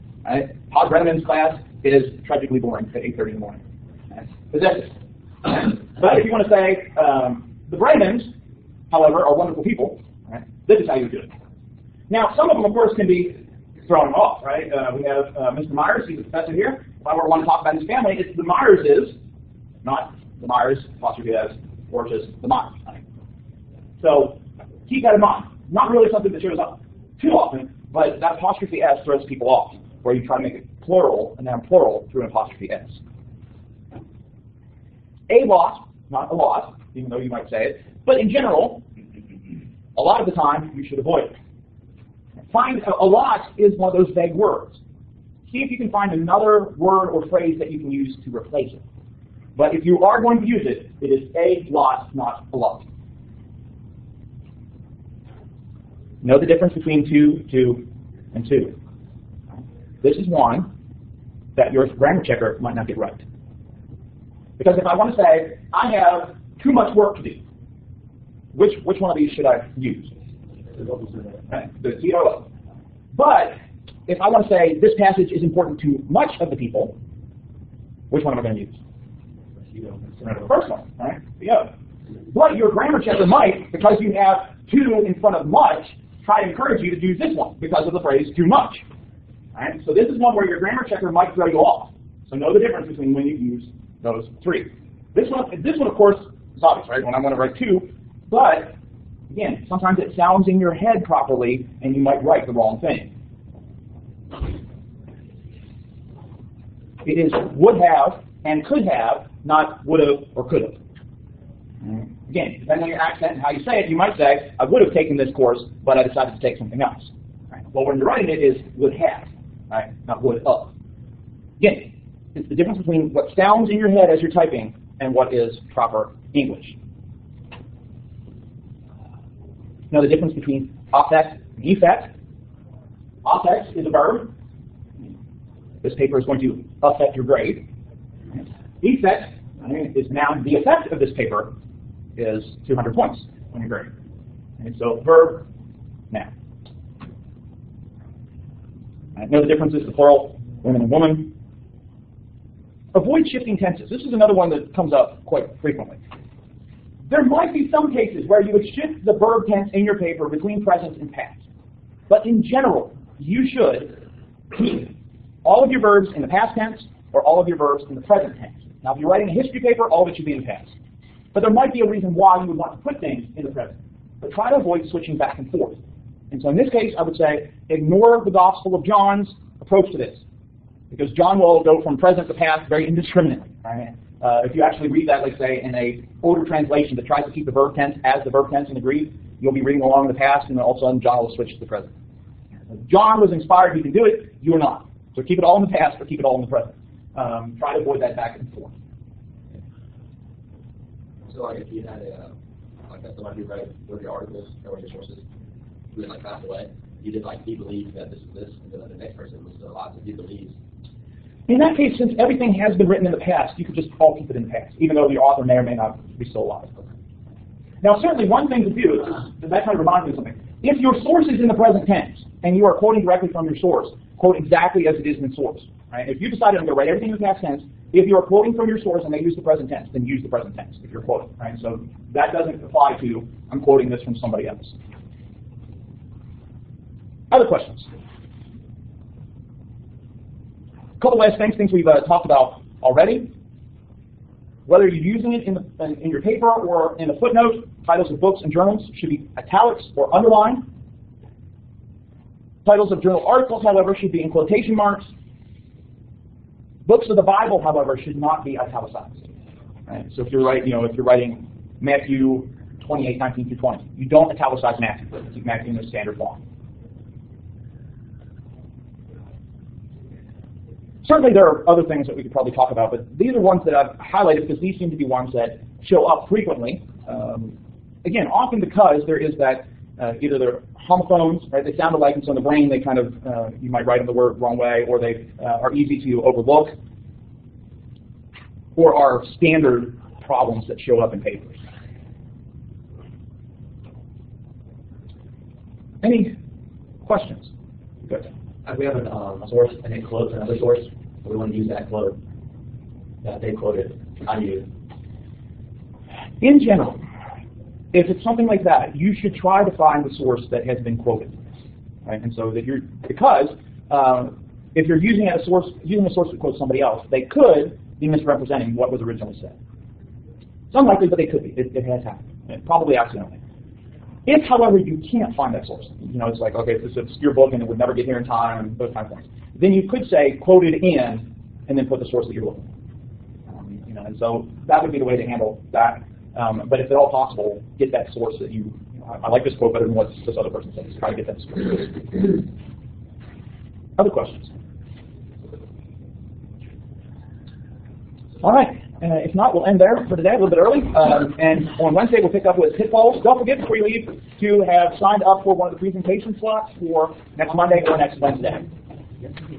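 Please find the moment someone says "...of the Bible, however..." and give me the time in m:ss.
4:17.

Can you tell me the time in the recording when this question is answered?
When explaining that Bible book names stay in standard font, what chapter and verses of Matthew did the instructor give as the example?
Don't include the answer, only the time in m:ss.
4:21.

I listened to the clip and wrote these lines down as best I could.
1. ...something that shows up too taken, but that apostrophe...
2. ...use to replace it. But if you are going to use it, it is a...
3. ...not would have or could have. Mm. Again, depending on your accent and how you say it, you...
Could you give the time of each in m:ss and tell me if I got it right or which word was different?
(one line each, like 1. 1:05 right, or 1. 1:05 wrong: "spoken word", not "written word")
1. 0:26 wrong: "often", not "taken"
2. 0:47 right
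3. 1:49 right.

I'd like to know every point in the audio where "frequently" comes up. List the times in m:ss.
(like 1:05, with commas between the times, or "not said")
2:35, 4:36.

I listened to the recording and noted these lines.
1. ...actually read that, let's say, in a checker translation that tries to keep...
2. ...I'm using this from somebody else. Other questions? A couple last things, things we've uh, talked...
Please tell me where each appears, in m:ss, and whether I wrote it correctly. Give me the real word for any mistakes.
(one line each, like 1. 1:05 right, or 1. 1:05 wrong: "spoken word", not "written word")
1. 3:04 wrong: "older", not "checker"
2. 3:53 wrong: "quoting", not "using".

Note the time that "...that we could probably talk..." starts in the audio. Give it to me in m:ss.
4:32.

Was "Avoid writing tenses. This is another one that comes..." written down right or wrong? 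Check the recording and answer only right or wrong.
wrong.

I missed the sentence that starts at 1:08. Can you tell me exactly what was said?
Which, which one of these should I use?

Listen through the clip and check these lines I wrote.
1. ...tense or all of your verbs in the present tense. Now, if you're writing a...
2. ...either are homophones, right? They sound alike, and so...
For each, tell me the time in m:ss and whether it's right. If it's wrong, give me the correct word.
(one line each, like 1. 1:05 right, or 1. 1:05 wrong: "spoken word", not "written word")
1. 2:46 right
2. 4:40 right.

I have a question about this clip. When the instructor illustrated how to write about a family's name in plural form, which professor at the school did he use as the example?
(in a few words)
Mr. Myers.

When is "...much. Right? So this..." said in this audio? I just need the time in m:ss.
1:28.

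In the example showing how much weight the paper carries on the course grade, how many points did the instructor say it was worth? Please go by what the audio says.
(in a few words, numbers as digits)
200.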